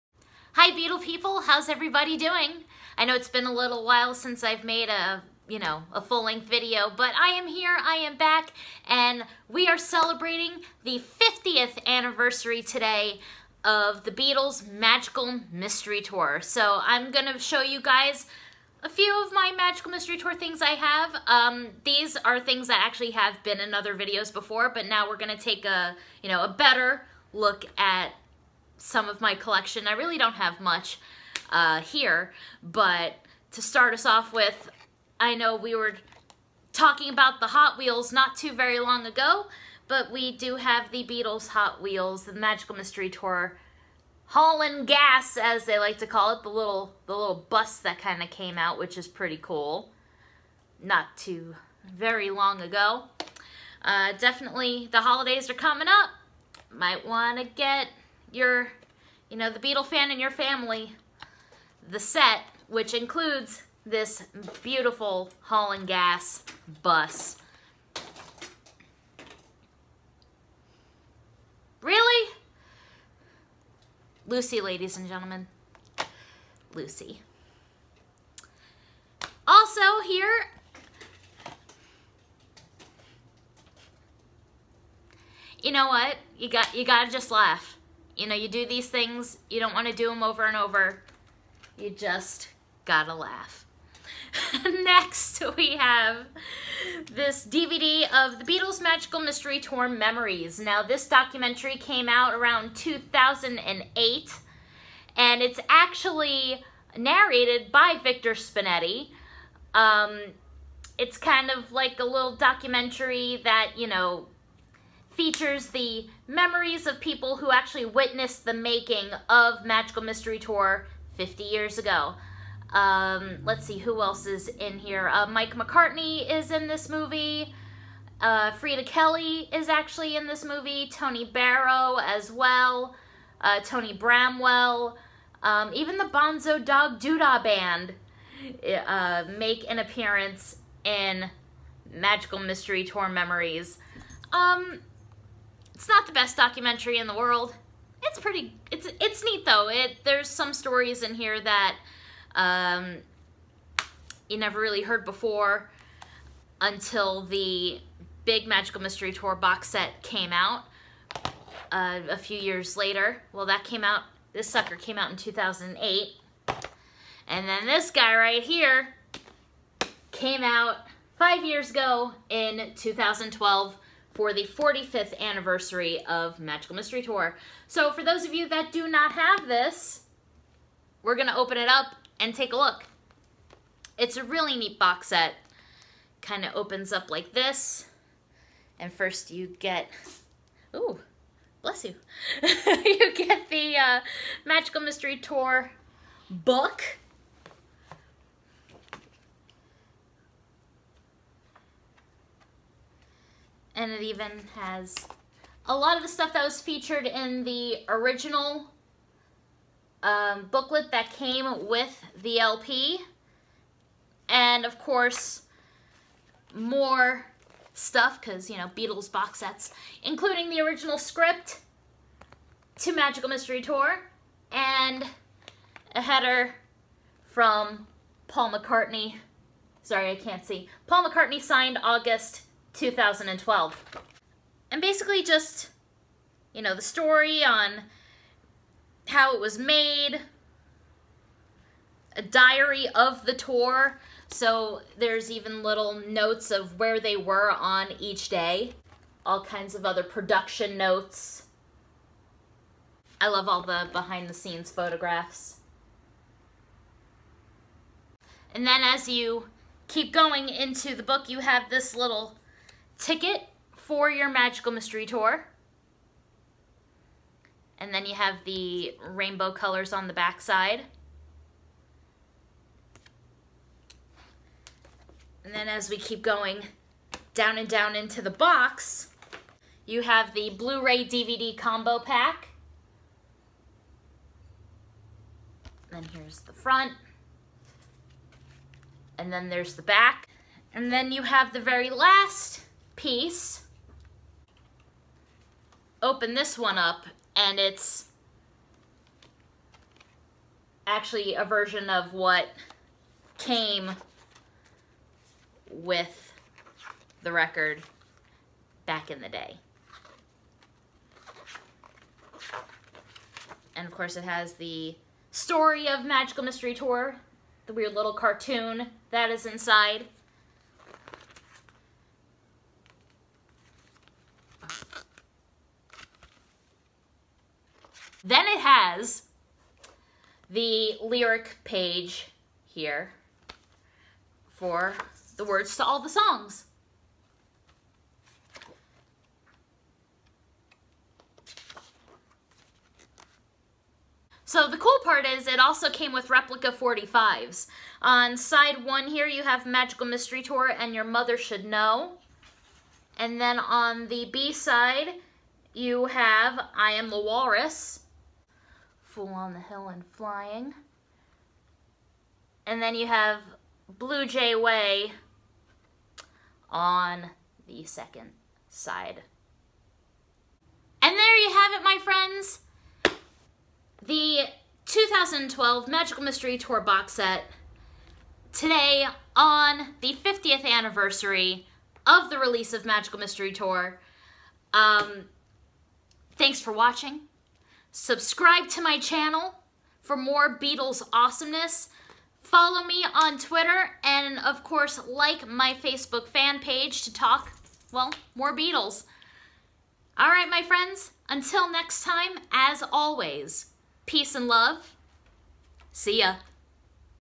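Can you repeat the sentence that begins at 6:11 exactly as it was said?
And there you have it, my friends.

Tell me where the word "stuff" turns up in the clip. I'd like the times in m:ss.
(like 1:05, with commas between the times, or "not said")
3:26, 3:37.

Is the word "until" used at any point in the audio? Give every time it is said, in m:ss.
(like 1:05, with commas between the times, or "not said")
2:36, 6:41.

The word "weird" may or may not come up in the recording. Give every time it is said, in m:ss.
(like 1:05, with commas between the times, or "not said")
5:17.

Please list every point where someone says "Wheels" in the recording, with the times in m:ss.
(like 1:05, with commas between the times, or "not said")
0:37, 0:41.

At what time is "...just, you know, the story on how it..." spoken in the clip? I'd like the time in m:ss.
3:55.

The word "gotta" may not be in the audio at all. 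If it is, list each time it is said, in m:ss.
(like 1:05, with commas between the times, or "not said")
1:26, 1:32.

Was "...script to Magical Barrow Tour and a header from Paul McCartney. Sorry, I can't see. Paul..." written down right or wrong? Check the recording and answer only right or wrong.
wrong.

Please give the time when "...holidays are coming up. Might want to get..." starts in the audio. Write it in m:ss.
0:55.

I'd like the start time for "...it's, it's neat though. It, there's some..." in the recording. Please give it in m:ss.
2:28.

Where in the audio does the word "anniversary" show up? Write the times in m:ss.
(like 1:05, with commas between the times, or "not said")
0:11, 2:55, 6:20.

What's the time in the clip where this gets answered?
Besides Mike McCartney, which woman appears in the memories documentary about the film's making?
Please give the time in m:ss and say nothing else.
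2:08.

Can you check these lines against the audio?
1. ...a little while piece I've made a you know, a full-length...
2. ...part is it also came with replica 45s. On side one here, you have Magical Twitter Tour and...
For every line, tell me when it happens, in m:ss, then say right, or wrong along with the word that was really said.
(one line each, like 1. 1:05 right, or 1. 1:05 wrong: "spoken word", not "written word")
1. 0:03 wrong: "since", not "piece"
2. 5:45 wrong: "Mystery", not "Twitter".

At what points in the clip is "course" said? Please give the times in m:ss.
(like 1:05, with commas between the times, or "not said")
3:34, 5:13, 6:34.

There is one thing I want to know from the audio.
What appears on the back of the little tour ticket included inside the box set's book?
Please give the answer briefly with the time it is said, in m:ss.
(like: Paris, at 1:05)
rainbow colors, at 4:29.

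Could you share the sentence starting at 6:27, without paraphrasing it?
Subscribe to my channel for more Beatles awesomeness.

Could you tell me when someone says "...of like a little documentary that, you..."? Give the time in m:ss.
1:51.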